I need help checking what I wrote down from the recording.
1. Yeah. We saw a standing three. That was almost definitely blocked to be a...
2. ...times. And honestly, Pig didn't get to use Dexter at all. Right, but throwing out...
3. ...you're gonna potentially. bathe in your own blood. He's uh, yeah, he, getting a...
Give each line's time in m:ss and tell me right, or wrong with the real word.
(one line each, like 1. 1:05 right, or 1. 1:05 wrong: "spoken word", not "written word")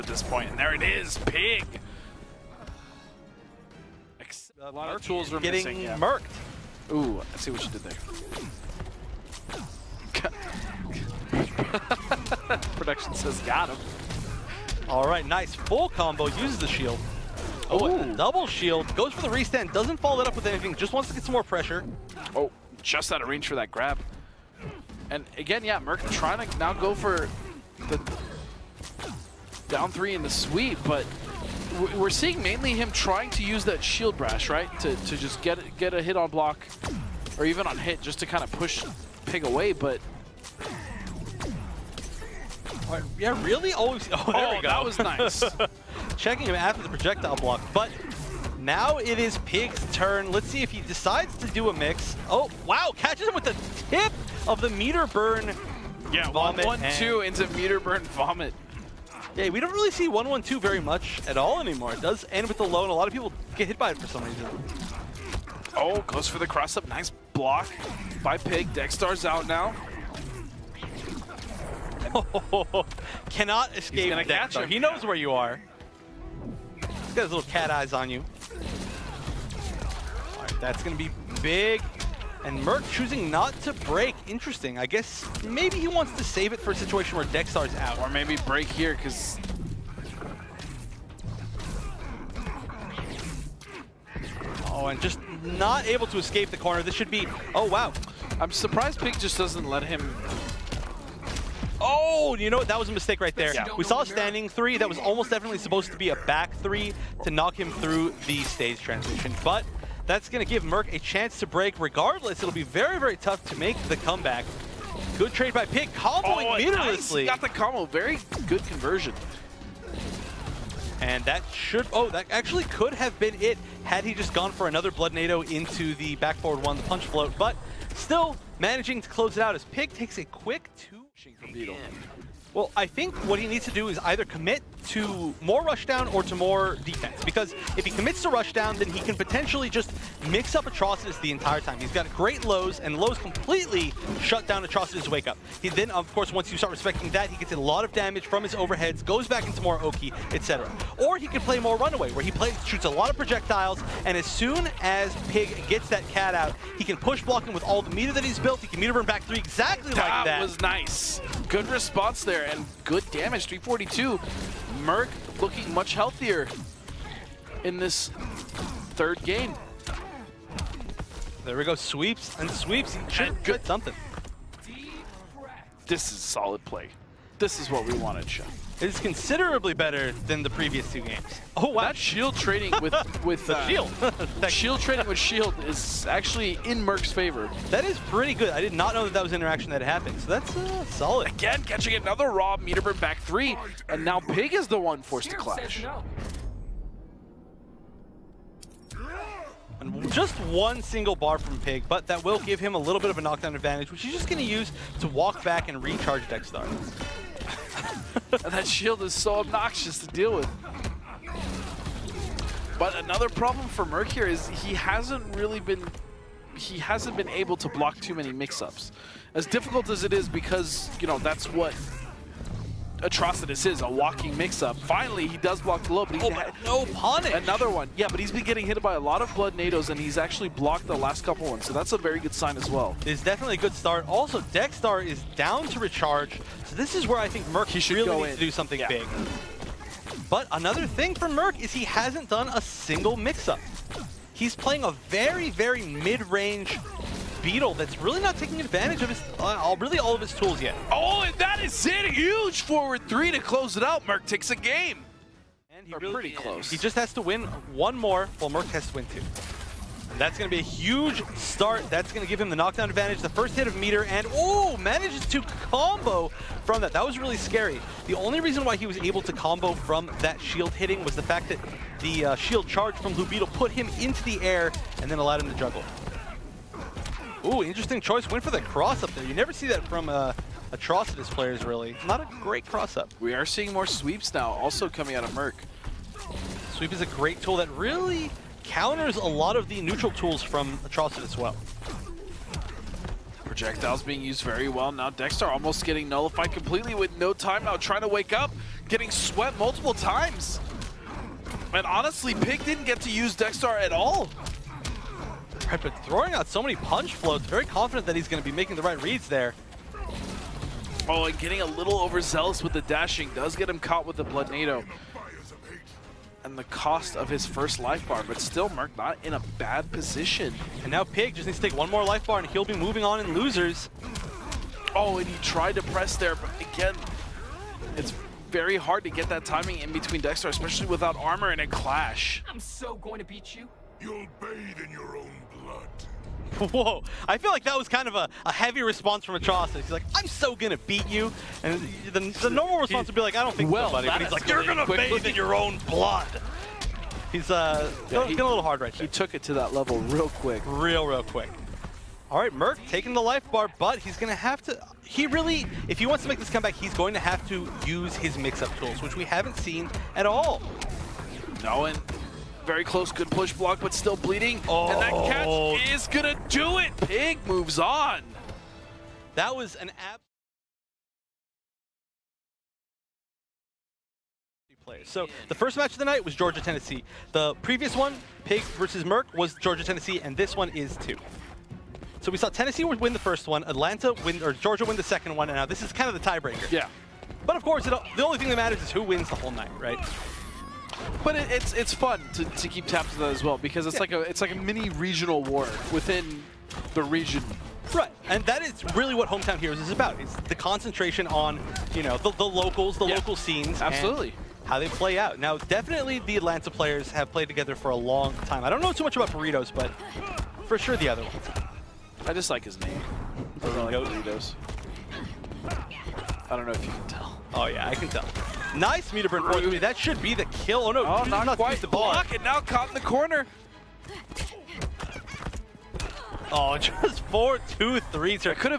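1. 1:43 wrong: "supposed", not "blocked"
2. 4:59 right
3. 5:44 wrong: "quickly", not "potentially".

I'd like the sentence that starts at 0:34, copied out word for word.
To, to just get get a hit on block or even on hit just to kind of push Pig away, but...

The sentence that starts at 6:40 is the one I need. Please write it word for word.
It's the concentration on you know the, the locals, the yeah.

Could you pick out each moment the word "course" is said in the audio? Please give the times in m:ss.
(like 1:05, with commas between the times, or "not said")
2:26, 6:27.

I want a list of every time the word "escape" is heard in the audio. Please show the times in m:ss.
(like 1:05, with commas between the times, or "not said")
1:13, 1:36.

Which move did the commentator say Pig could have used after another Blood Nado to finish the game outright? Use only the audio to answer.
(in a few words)
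Punch float.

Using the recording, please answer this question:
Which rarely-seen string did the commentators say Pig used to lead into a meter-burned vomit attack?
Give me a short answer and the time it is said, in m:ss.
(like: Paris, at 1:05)
1-1-2, at 0:56.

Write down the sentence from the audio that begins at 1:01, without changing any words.
It does end with the low, and a lot of people get hit by it for some reason.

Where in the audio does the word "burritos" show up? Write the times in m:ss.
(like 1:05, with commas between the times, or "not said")
6:49, 6:53.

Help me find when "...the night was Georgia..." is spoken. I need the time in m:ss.
6:15.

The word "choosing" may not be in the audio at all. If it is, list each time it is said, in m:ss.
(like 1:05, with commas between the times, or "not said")
1:22.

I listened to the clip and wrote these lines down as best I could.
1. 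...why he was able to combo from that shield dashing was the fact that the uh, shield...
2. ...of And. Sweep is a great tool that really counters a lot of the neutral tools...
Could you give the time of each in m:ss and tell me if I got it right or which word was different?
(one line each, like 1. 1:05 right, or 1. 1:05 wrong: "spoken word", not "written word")
1. 4:28 wrong: "hitting", not "dashing"
2. 4:45 wrong: "Murk", not "And".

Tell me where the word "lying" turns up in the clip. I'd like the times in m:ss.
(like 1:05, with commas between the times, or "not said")
not said.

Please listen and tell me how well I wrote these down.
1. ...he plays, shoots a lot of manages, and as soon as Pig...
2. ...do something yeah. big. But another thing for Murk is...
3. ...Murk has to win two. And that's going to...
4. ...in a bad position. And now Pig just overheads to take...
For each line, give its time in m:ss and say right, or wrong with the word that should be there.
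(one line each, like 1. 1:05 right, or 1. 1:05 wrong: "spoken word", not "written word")
1. 2:32 wrong: "projectiles", not "manages"
2. 3:58 right
3. 4:18 right
4. 5:19 wrong: "needs", not "overheads".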